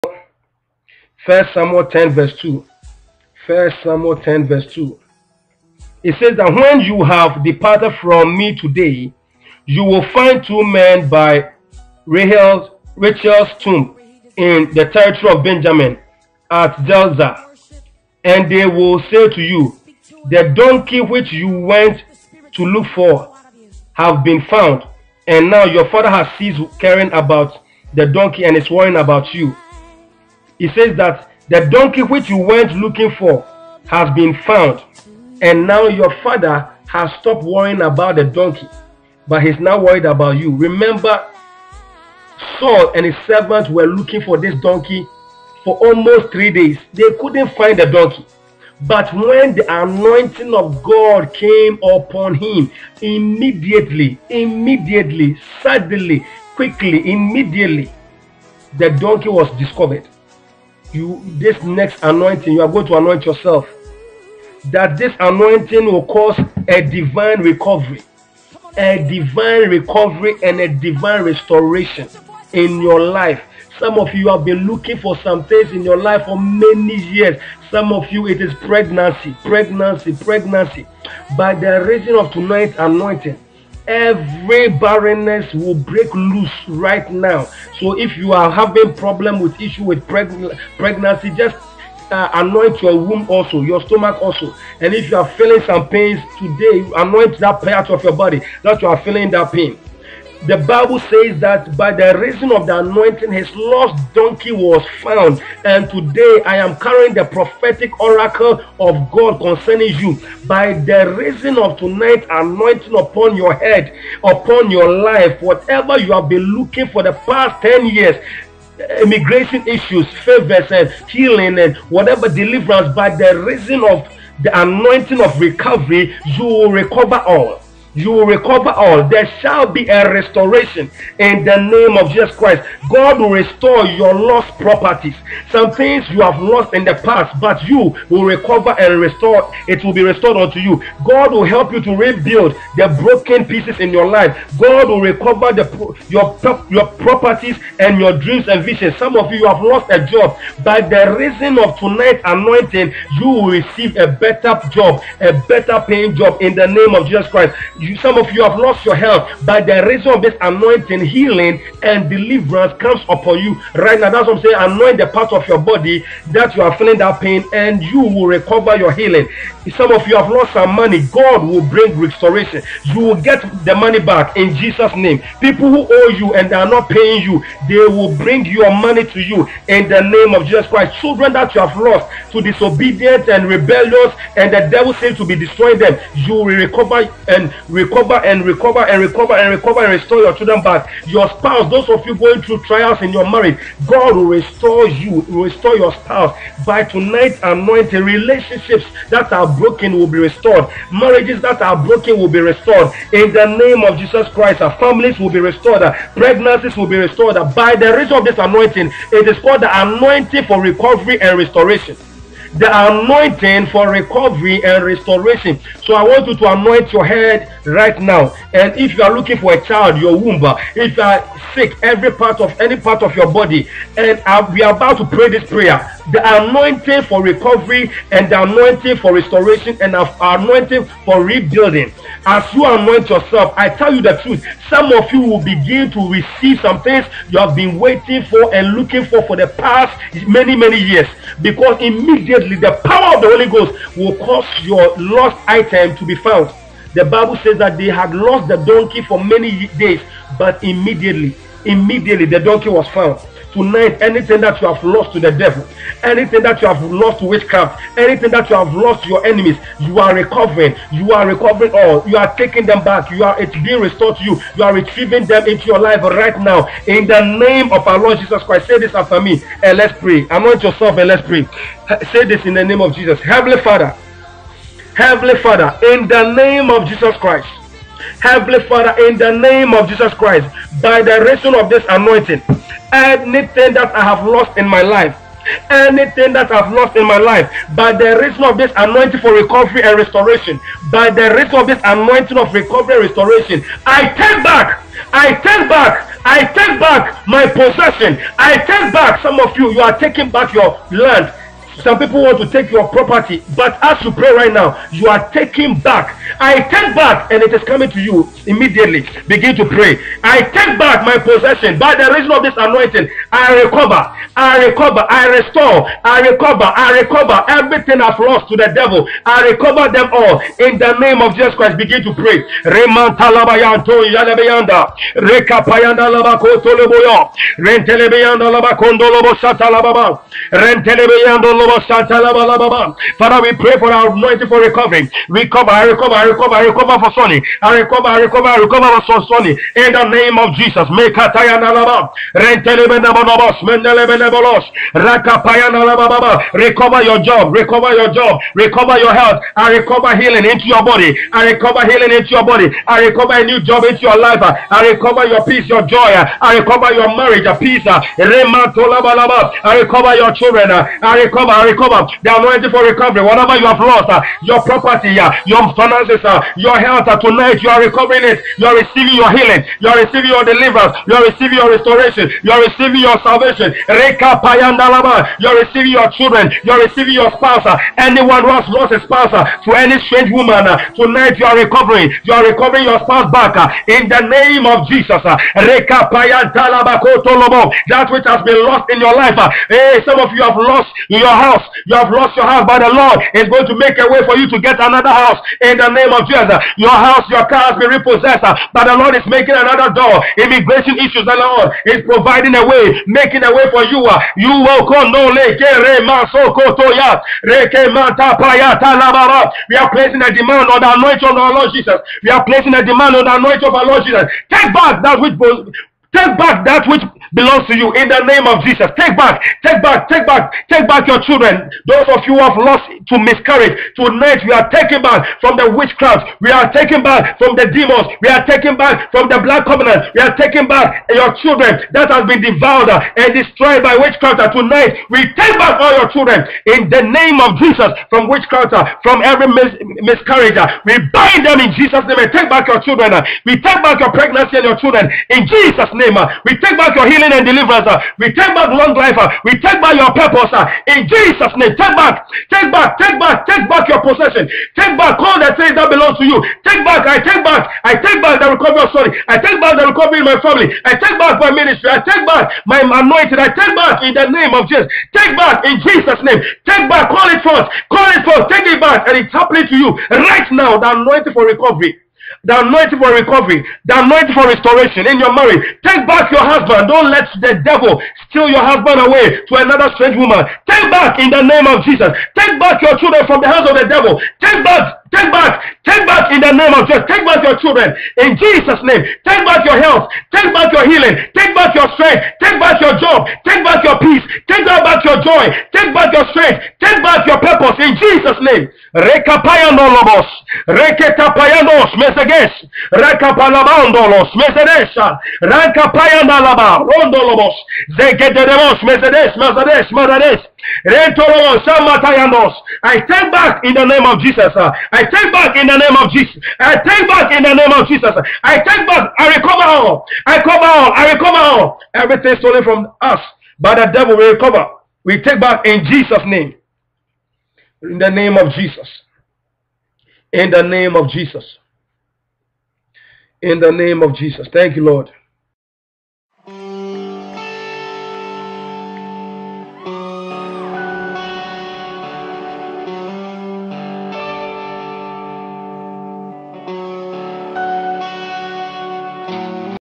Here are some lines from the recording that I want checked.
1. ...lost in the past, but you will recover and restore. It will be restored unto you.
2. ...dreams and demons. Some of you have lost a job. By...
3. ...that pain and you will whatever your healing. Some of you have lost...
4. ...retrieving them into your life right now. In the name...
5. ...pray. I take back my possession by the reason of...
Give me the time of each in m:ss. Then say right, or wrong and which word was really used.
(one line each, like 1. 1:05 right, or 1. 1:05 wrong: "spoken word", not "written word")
1. 2:16 right
2. 2:28 wrong: "visions", not "demons"
3. 2:46 wrong: "recover", not "whatever"
4. 4:24 right
5. 5:09 right.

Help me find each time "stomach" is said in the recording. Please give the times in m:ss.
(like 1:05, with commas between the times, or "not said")
1:33.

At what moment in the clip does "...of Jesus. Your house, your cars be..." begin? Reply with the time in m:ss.
6:36.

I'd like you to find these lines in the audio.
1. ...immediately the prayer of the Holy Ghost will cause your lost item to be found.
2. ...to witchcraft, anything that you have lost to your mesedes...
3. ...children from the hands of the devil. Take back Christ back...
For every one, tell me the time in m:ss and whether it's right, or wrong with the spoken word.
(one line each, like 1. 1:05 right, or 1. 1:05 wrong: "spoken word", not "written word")
1. 4:01 wrong: "power", not "prayer"
2. 4:17 wrong: "enemies", not "mesedes"
3. 8:02 wrong: "Take", not "Christ".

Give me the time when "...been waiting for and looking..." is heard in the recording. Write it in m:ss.
3:57.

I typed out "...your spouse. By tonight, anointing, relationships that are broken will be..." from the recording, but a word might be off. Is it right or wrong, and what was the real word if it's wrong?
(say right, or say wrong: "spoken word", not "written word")
right.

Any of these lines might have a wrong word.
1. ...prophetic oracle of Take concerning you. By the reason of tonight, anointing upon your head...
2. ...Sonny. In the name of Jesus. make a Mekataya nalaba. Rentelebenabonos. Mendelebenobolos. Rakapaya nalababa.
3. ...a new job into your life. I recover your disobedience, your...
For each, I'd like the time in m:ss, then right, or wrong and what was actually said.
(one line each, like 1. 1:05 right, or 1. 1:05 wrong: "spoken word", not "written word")
1. 1:47 wrong: "God", not "Take"
2. 5:39 right
3. 5:53 wrong: "peace", not "disobedience".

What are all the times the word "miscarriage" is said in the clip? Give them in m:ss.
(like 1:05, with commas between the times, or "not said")
7:03, 7:20.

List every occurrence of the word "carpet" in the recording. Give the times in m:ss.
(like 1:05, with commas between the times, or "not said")
not said.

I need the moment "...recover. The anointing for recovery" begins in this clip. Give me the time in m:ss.
6:01.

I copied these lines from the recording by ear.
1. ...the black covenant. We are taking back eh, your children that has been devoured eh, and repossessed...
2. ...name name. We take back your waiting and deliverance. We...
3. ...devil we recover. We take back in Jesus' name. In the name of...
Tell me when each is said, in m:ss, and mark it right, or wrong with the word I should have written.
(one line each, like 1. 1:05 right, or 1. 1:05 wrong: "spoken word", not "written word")
1. 7:09 wrong: "destroyed", not "repossessed"
2. 7:25 wrong: "healing", not "waiting"
3. 8:43 right.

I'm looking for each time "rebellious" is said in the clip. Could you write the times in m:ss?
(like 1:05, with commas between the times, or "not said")
3:03.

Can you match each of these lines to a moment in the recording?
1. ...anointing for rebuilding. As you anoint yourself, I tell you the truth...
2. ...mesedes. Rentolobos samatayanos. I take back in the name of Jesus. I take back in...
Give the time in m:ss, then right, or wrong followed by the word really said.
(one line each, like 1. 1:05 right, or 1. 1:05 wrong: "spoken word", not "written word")
1. 3:50 right
2. 8:29 right.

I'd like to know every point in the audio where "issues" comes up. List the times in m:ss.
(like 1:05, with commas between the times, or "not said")
1:29, 1:59, 6:40.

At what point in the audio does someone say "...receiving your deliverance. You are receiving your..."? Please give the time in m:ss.
6:10.